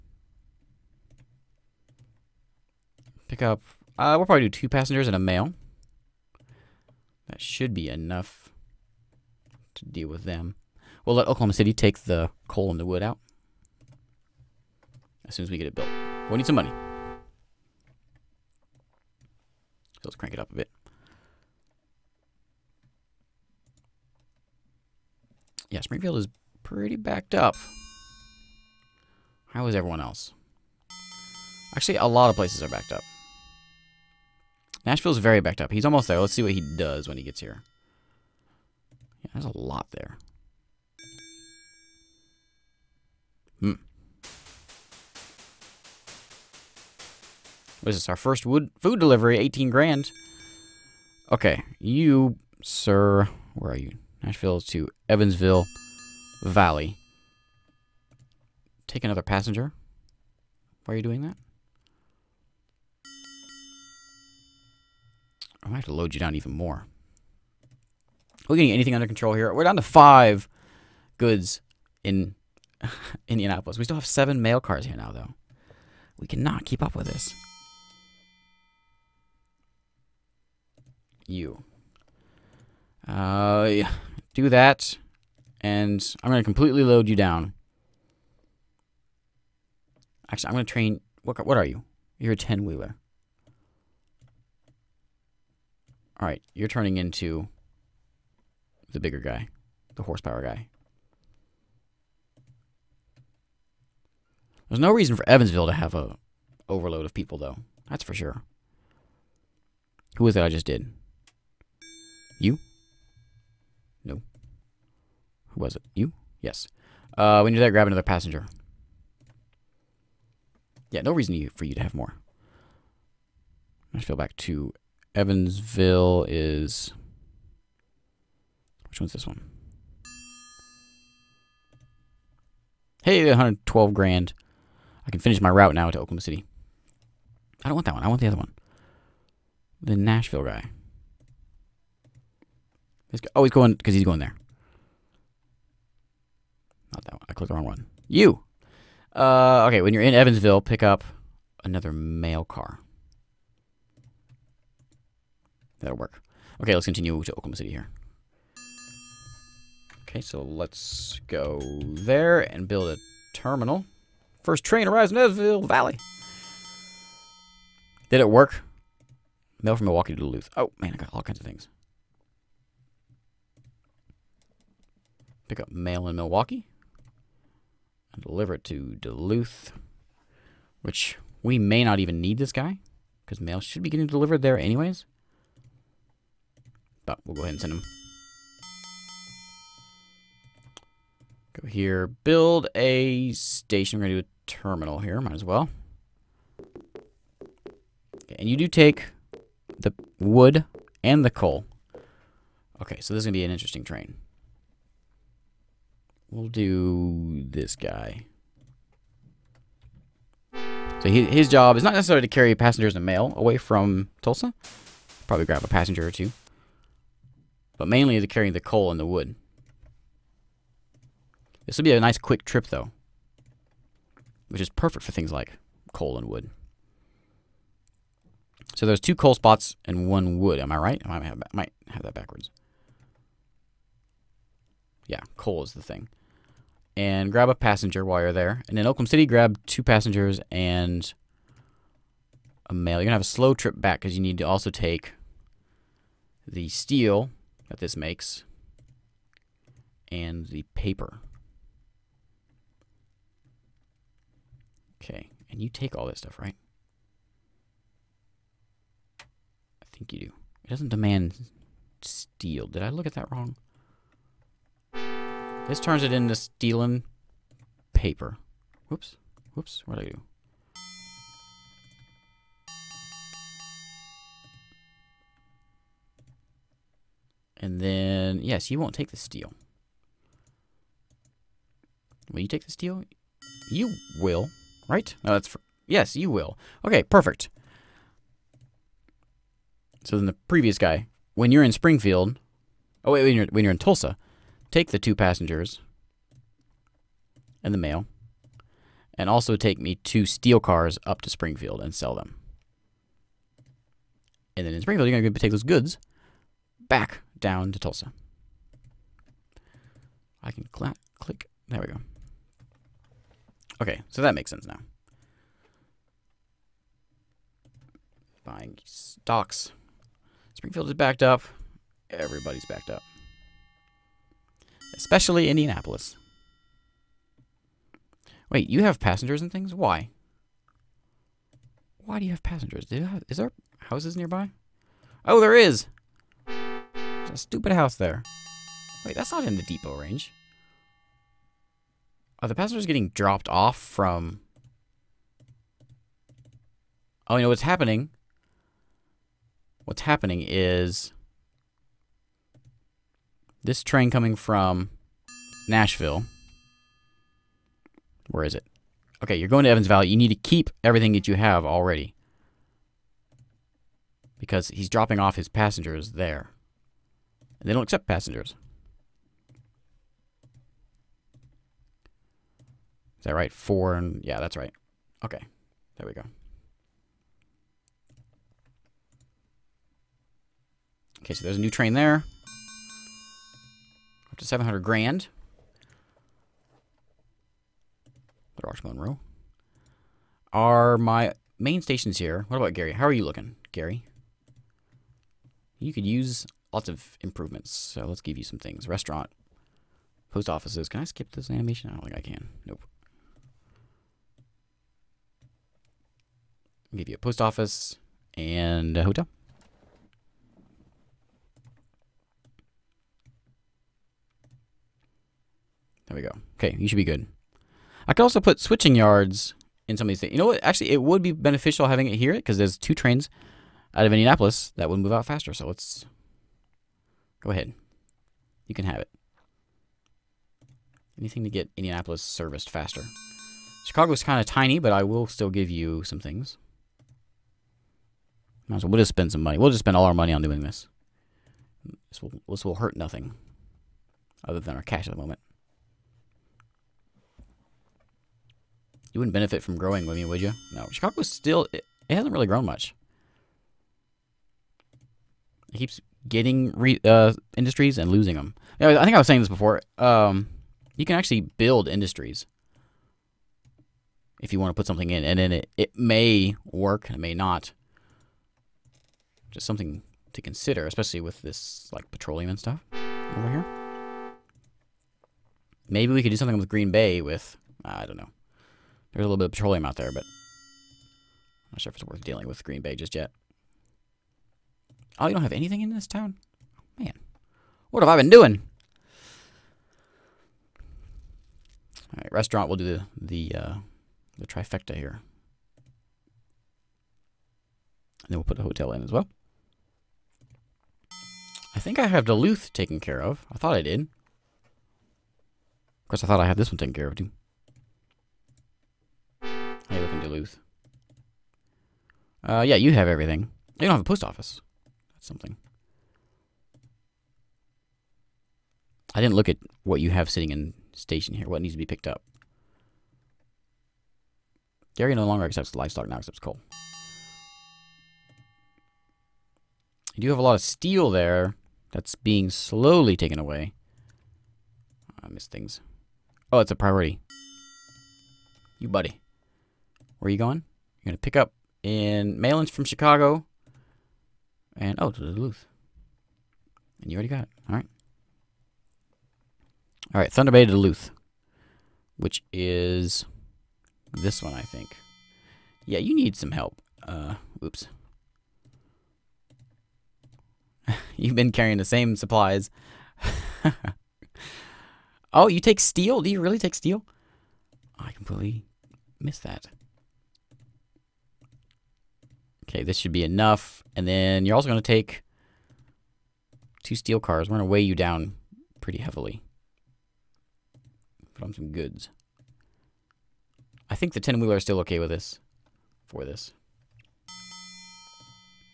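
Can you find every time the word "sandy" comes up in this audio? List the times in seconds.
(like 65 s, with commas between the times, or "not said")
not said.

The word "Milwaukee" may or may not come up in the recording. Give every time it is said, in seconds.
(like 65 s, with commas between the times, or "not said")
169 s, 176 s.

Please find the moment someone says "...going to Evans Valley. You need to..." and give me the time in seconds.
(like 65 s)
359 s.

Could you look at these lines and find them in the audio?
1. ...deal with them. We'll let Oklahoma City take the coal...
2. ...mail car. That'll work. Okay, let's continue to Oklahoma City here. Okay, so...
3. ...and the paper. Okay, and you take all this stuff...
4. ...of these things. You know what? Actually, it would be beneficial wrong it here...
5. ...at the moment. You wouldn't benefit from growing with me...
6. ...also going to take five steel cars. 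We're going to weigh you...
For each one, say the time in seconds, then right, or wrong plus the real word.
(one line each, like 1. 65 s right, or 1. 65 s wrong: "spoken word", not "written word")
1. 9 s right
2. 151 s right
3. 250 s right
4. 420 s wrong: "having", not "wrong"
5. 445 s right
6. 574 s wrong: "two", not "five".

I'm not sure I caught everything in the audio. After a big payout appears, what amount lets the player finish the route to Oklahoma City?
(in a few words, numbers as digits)
112 grand.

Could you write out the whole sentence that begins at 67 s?
Are we getting anything under control here?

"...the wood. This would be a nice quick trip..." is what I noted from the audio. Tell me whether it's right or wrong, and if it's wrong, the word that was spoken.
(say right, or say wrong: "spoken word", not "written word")
right.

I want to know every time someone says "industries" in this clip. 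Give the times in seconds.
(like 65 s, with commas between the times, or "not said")
457 s, 461 s.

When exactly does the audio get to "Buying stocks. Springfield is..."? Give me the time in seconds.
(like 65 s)
318 s.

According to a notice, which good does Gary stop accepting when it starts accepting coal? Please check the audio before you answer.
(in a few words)
livestock.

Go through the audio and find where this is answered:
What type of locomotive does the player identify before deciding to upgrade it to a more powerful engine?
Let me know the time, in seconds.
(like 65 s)
92 s.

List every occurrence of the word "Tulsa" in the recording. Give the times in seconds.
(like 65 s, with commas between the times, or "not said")
214 s, 293 s, 307 s.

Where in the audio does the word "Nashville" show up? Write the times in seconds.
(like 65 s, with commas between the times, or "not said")
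34 s, 54 s, 139 s, 355 s.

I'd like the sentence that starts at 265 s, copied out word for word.
This turns it into stealing paper.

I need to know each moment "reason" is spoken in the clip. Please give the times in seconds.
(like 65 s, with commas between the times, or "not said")
104 s, 121 s.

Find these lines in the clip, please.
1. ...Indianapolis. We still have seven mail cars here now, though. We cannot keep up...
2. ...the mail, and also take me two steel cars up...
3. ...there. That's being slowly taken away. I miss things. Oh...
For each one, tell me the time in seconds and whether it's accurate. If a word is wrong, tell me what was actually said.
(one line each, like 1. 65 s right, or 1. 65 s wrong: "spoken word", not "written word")
1. 73 s right
2. 297 s right
3. 531 s right.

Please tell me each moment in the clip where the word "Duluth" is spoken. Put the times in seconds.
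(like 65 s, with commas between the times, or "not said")
170 s, 178 s, 502 s, 510 s, 545 s, 550 s.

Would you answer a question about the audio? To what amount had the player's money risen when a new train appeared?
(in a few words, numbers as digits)
700 grand.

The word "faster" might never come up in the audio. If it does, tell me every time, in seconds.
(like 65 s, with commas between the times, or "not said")
425 s, 432 s.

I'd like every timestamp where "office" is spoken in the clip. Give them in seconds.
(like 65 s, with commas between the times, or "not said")
400 s, 407 s, 514 s.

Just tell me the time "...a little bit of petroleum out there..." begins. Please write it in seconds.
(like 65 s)
479 s.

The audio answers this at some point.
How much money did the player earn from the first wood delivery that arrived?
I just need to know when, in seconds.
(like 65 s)
49 s.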